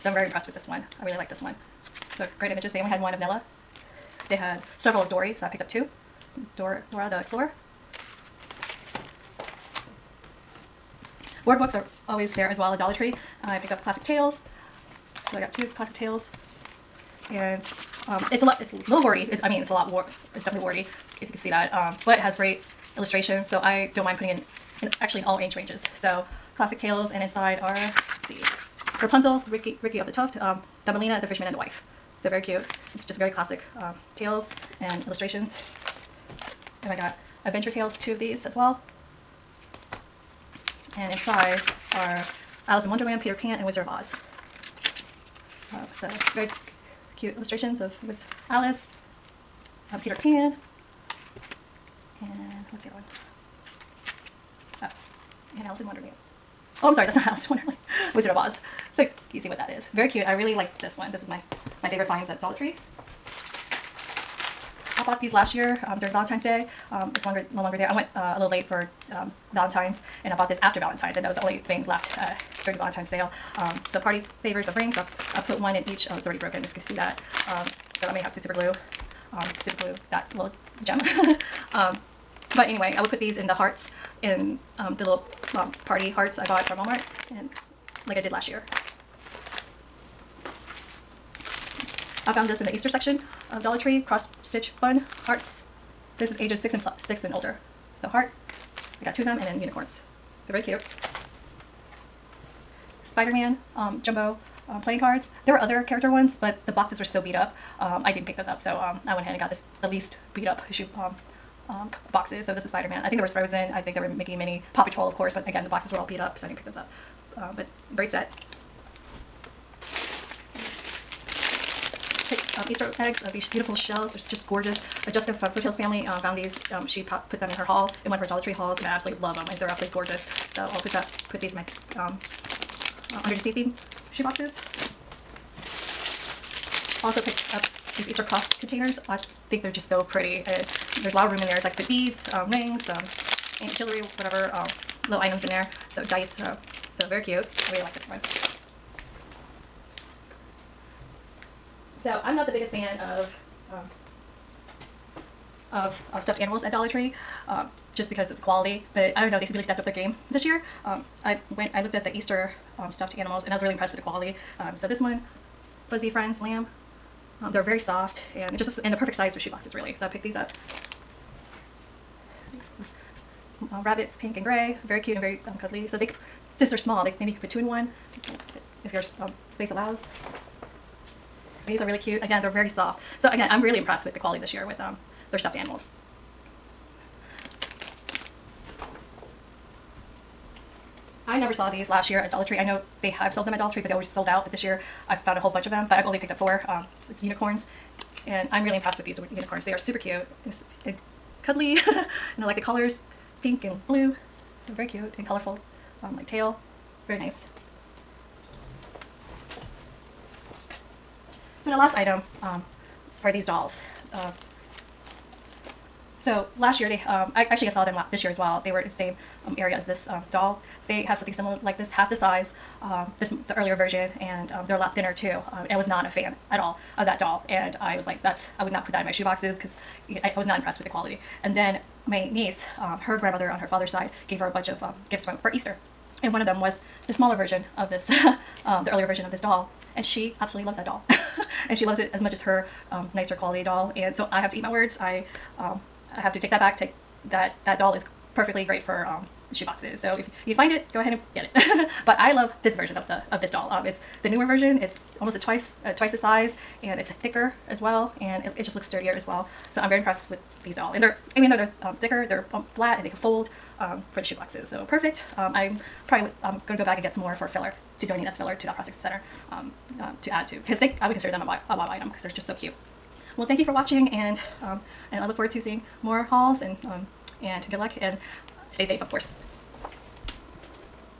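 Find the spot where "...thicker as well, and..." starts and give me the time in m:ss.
4:17.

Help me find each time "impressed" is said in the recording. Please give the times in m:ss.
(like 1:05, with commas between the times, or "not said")
0:00, 2:43, 3:03, 3:18, 3:50, 4:19.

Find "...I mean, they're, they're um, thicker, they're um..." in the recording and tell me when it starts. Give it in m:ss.
4:21.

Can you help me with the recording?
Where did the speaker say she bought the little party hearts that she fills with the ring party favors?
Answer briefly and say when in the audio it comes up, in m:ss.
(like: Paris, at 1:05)
Walmart, at 1:26.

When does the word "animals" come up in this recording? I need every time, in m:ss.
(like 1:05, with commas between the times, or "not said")
2:36, 2:43, 3:05.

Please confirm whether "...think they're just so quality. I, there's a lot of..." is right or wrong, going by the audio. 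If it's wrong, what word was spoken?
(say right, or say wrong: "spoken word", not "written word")
wrong: "pretty", not "quality".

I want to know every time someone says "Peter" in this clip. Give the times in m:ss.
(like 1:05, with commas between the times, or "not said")
0:43, 0:50.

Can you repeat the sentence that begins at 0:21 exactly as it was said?
Um, but it has great illustrations, so I don't mind putting in, in actually in all age ranges.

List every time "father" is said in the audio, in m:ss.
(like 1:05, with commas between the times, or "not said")
3:53.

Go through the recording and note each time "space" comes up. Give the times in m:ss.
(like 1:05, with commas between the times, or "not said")
2:59.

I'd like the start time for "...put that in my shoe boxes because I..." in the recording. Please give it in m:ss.
3:48.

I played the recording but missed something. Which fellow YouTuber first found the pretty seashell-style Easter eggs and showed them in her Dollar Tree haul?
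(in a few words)
Jessica.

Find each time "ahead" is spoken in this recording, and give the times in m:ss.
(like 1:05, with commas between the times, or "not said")
1:49, 4:11.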